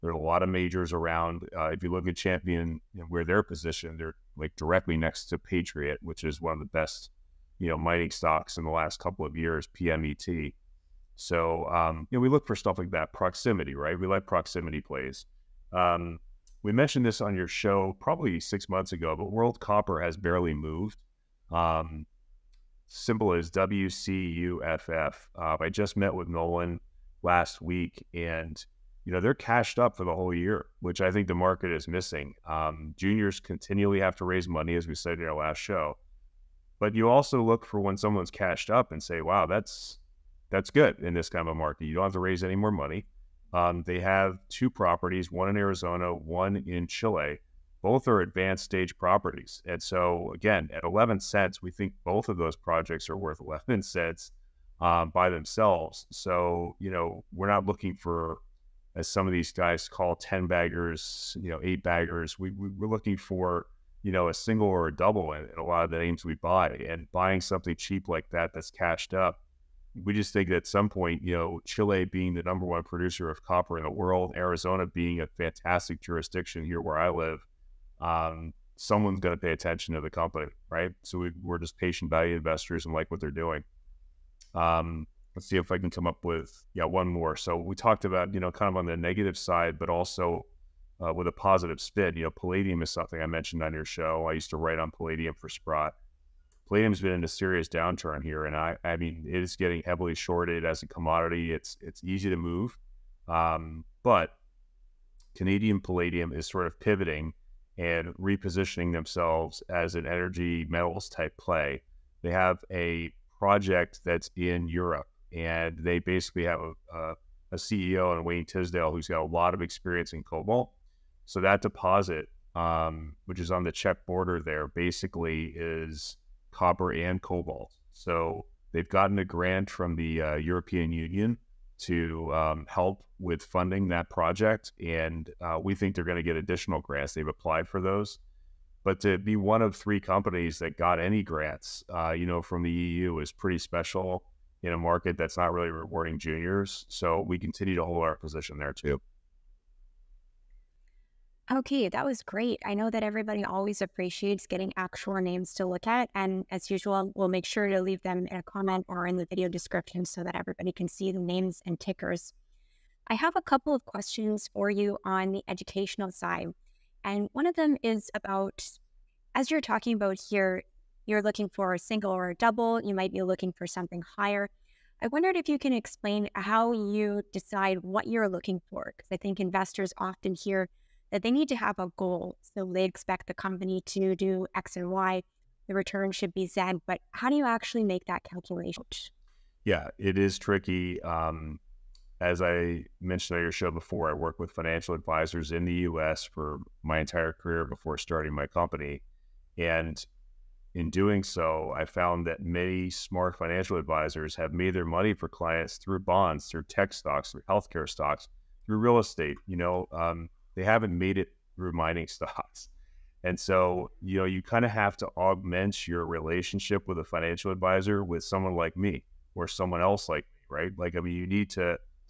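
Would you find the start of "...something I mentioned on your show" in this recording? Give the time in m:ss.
1:32.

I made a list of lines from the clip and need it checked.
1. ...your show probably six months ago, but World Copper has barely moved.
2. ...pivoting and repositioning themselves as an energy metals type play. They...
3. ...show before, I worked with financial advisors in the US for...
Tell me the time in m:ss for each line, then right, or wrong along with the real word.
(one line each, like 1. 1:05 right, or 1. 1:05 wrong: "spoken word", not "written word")
1. 0:17 right
2. 1:46 right
3. 3:13 right.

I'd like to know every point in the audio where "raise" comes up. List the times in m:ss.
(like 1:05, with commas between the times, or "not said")
0:34, 0:42.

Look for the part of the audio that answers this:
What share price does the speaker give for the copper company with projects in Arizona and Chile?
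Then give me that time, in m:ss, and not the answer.
0:50.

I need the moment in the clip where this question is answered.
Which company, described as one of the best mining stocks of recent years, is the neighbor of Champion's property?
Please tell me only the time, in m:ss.
0:05.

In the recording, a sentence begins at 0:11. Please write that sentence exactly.
So um, you know we look for stuff like that, proximity, right?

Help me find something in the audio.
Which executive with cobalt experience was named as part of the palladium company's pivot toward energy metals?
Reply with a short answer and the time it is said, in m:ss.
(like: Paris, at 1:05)
Wayne Tisdale, at 1:58.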